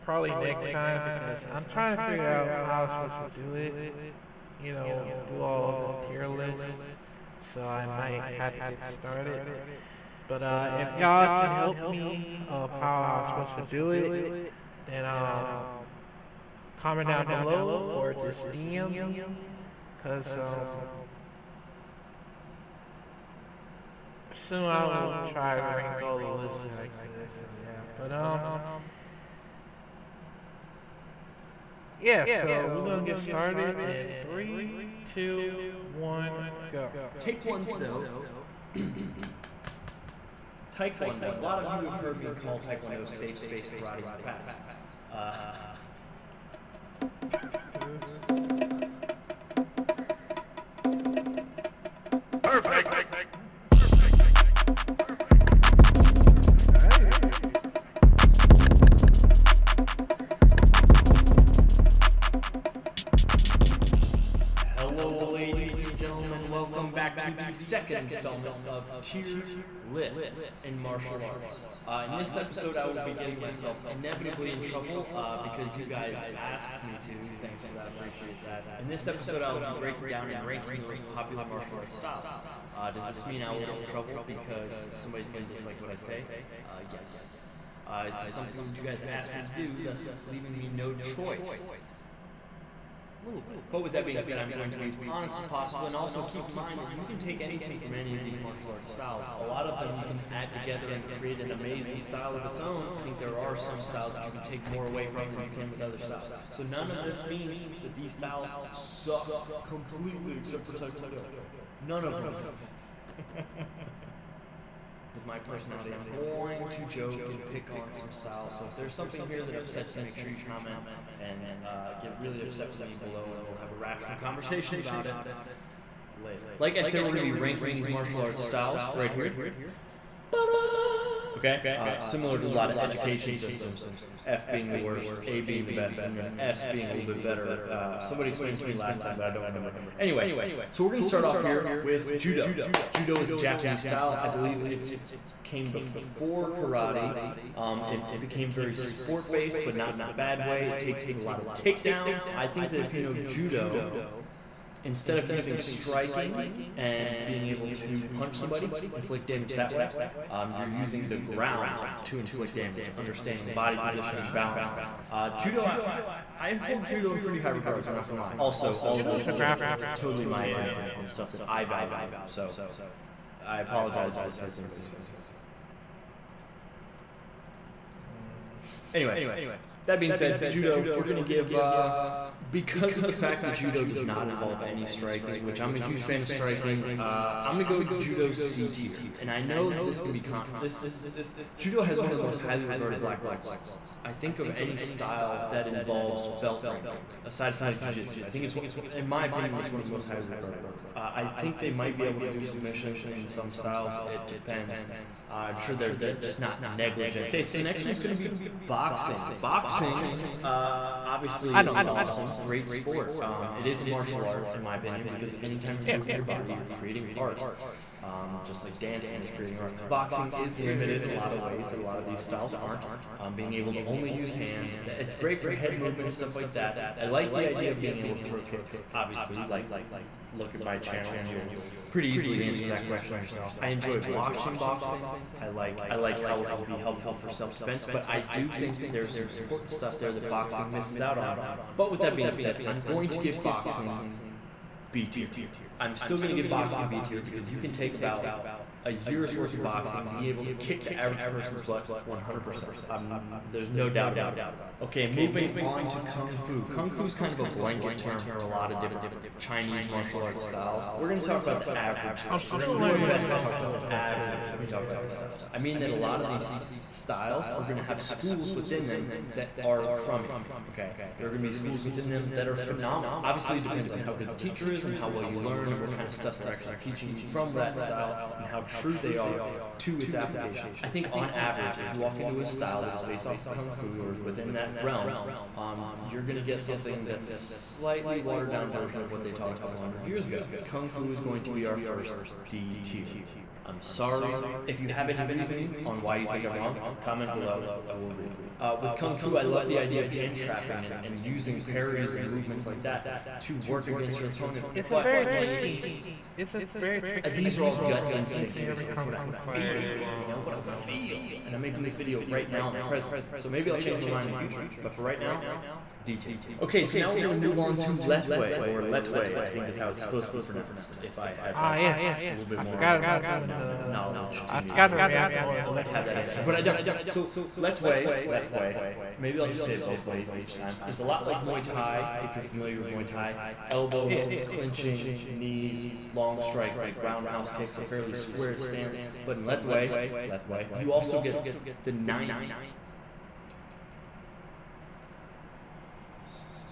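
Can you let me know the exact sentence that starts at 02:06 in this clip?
Like I said, we're going to be ranking these martial arts styles right here.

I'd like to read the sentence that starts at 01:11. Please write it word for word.
Uh, in this episode, I will be getting myself inevitably in trouble uh, because you guys asked me to.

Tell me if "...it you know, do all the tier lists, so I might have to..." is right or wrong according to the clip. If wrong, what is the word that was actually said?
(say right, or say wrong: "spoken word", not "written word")
right.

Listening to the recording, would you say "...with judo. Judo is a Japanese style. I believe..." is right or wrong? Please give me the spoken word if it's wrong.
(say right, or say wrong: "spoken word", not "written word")
right.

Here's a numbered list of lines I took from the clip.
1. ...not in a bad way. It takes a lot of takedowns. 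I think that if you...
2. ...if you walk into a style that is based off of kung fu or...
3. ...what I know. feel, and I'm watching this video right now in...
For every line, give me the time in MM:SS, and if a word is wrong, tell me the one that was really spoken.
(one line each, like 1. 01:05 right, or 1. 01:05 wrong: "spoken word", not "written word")
1. 02:29 right
2. 04:41 right
3. 05:10 wrong: "making", not "watching".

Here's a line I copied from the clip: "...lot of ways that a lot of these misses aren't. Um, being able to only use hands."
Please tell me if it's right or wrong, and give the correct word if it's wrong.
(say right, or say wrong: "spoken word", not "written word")
wrong: "styles", not "misses".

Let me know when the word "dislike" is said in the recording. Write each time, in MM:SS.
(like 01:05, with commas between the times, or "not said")
01:25.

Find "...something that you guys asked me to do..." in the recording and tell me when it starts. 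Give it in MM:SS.
01:28.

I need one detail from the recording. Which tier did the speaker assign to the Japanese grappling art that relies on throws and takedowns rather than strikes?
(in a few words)
C tier.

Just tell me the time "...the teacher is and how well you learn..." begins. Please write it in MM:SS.
04:34.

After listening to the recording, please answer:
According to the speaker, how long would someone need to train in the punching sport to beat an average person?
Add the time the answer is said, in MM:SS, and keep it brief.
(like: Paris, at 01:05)
a year, at 04:08.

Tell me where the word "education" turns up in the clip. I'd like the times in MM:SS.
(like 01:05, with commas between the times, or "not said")
02:12.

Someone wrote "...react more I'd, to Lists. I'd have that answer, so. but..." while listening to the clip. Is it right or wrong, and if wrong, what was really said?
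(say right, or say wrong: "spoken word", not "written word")
wrong: "Lethway", not "Lists".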